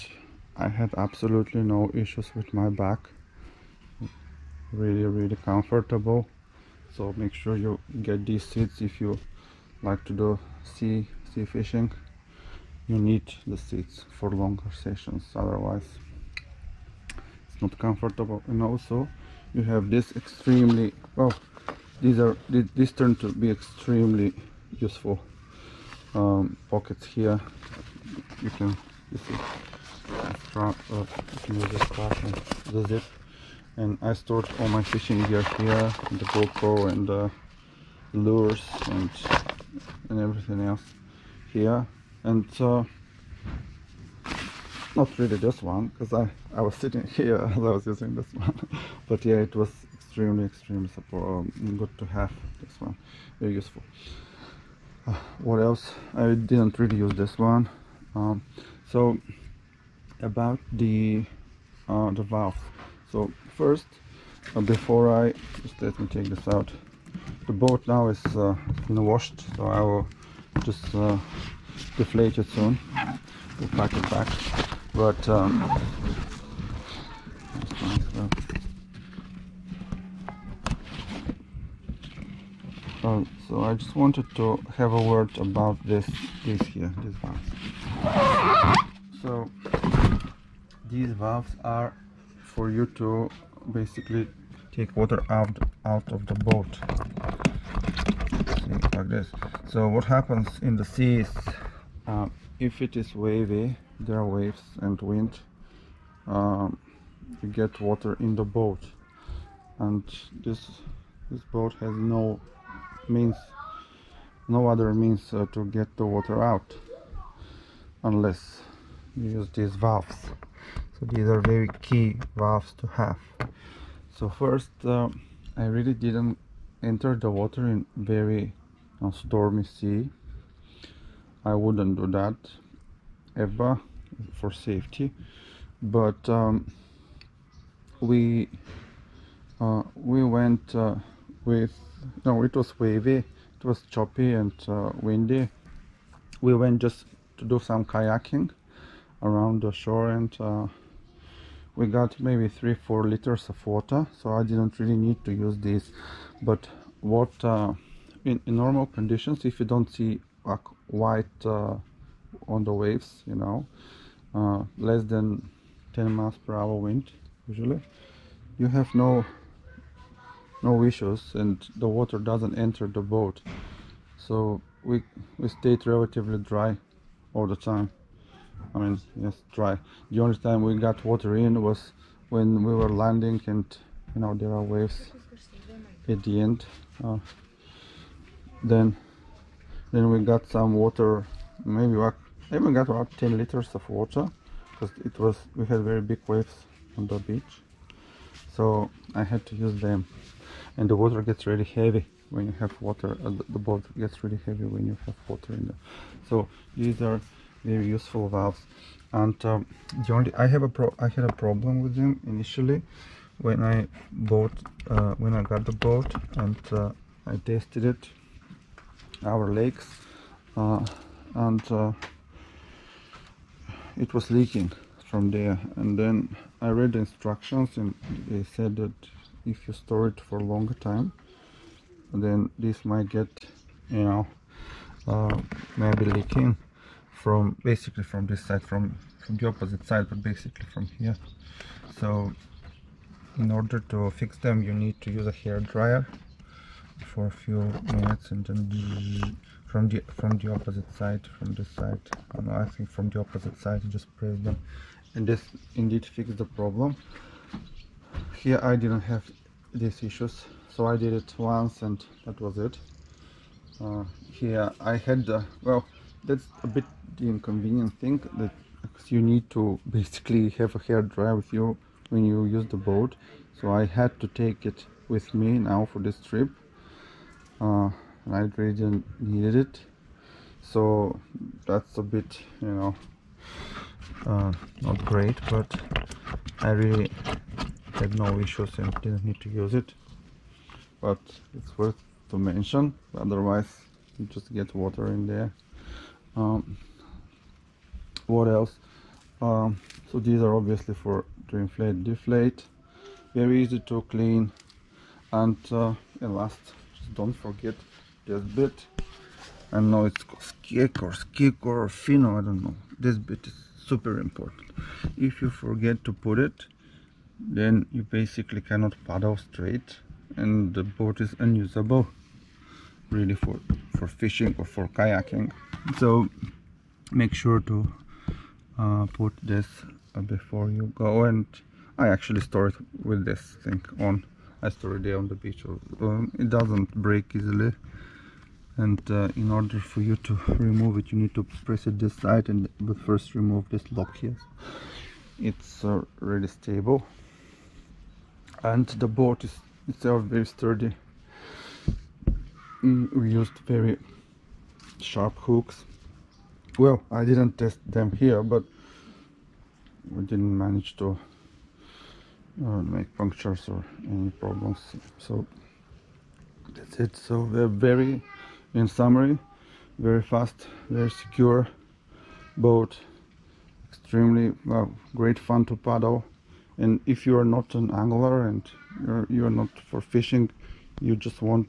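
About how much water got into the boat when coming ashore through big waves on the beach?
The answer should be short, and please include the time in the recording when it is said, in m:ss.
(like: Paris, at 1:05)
10 liters, at 3:13.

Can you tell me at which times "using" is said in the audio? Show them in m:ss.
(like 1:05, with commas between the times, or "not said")
0:47.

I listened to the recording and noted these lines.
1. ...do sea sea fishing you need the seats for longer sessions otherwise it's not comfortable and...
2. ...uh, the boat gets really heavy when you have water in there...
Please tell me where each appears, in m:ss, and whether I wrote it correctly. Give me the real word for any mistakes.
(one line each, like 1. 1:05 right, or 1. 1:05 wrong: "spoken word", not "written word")
1. 0:10 right
2. 3:23 right.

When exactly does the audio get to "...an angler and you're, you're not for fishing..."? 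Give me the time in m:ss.
6:17.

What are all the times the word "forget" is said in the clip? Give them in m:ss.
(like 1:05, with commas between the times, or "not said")
5:07, 5:15.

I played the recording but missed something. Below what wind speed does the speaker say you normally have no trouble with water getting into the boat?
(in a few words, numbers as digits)
10 miles per hour.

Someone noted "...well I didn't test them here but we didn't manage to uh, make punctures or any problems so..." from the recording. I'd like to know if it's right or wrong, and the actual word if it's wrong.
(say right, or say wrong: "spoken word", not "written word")
right.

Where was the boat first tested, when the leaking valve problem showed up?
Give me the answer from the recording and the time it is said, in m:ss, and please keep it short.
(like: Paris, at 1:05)
Lakes, at 3:39.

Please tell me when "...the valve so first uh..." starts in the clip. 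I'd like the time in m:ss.
1:02.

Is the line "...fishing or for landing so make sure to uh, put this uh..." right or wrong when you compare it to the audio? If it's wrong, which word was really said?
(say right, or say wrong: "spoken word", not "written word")
wrong: "kayaking", not "landing".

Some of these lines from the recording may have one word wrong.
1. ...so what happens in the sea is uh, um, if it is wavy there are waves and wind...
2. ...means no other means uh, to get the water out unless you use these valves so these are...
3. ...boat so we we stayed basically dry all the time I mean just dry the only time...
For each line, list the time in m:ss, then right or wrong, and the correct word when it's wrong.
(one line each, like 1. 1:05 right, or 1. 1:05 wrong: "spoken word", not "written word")
1. 1:39 right
2. 1:53 right
3. 2:53 wrong: "relatively", not "basically".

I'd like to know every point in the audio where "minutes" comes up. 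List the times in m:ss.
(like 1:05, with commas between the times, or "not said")
4:07.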